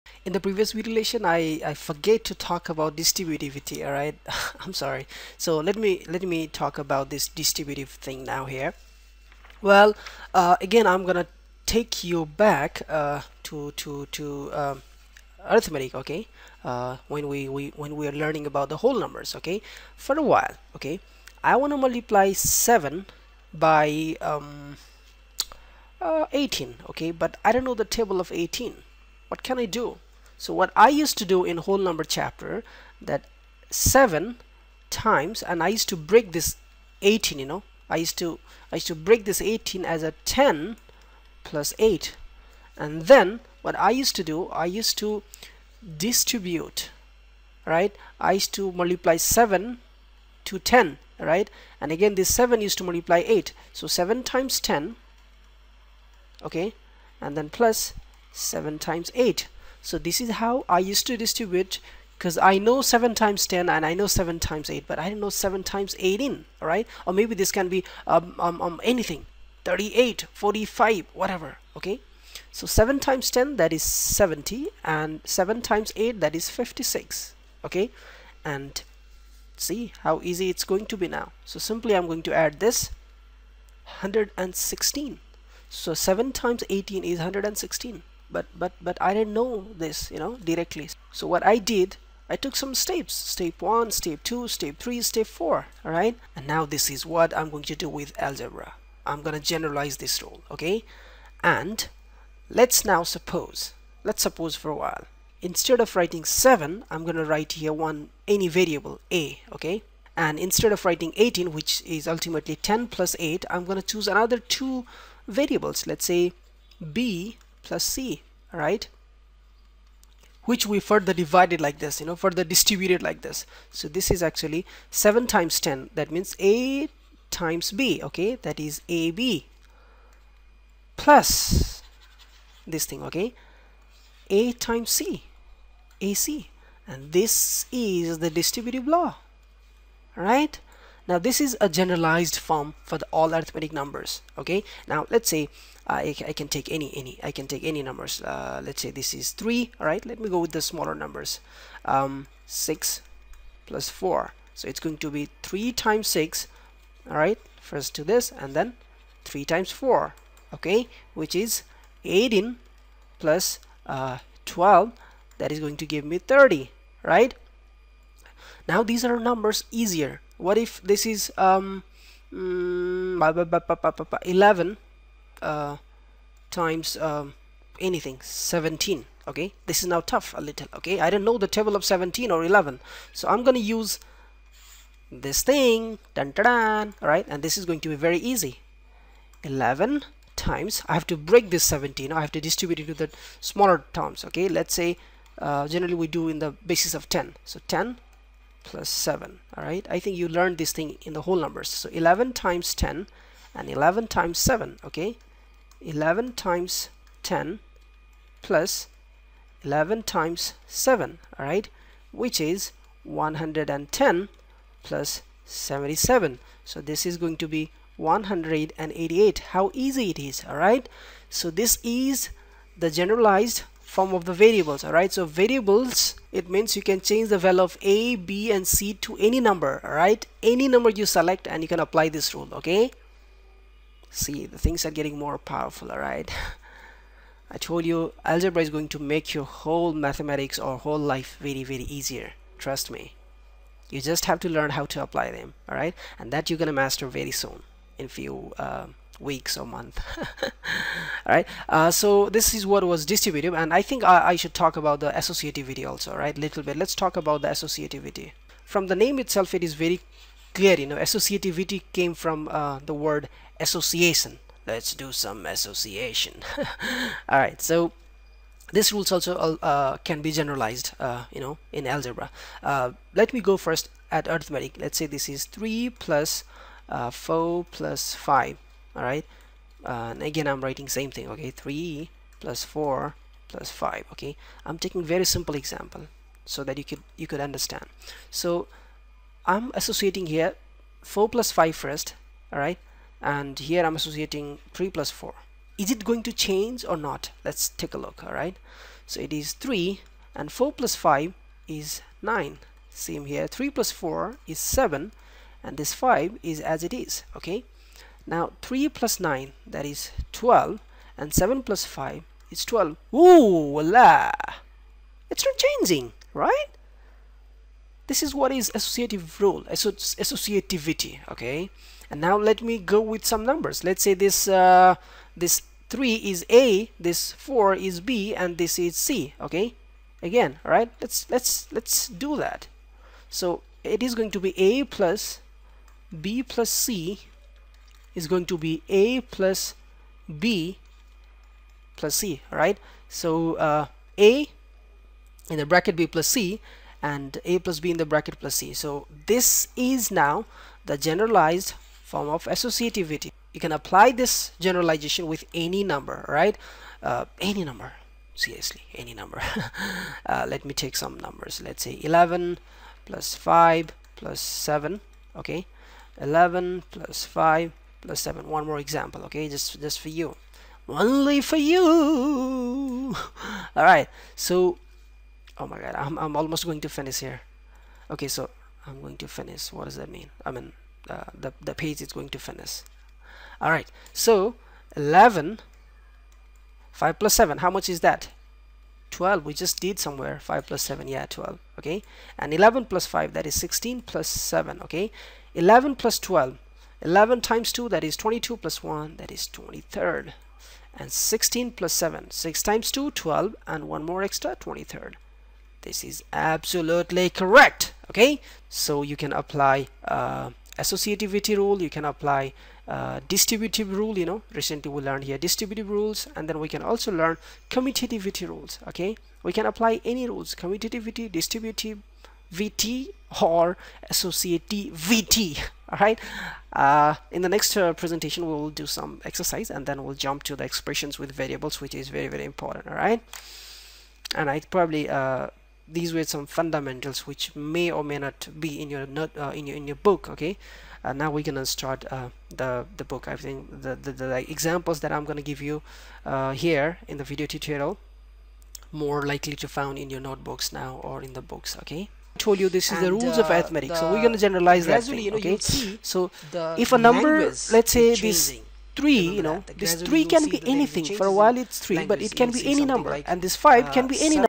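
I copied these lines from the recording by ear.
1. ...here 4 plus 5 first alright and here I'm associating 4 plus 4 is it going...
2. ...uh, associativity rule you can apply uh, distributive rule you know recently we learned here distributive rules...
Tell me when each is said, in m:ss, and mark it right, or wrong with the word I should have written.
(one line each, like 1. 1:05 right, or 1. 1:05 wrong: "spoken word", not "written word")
1. 4:50 wrong: "3", not "4"
2. 6:50 right.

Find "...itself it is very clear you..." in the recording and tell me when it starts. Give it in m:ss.
4:19.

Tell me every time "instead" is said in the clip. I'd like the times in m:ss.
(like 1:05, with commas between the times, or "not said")
1:45, 1:50.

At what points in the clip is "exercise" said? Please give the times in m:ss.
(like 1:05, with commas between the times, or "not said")
7:09.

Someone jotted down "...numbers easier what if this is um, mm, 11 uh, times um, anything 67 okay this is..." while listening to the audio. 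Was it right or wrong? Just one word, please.
wrong.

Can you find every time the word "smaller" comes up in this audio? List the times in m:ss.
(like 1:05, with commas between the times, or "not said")
2:30, 3:13.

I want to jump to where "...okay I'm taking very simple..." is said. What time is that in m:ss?
4:44.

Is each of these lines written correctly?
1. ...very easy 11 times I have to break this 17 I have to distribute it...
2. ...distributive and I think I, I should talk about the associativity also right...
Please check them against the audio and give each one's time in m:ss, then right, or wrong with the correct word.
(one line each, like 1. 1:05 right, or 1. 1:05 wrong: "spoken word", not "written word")
1. 3:07 right
2. 4:13 right.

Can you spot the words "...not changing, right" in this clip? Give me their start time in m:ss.
5:15.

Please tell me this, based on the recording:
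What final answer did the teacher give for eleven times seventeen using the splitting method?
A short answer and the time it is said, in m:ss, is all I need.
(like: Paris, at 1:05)
188, at 3:37.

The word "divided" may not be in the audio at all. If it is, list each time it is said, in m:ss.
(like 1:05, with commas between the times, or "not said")
2:01.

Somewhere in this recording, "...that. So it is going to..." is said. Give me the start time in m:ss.
5:32.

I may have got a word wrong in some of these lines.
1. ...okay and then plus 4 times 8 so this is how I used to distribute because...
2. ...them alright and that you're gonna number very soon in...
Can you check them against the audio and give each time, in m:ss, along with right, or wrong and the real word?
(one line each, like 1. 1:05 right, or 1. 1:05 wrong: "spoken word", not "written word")
1. 0:56 wrong: "7", not "4"
2. 4:05 wrong: "master", not "number".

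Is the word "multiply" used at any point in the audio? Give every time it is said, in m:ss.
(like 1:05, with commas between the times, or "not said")
0:21, 0:48, 0:52.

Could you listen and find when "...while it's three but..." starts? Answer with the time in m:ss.
7:41.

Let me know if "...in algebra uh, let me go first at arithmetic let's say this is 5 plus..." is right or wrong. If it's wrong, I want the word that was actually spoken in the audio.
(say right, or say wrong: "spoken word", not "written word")
wrong: "3", not "5".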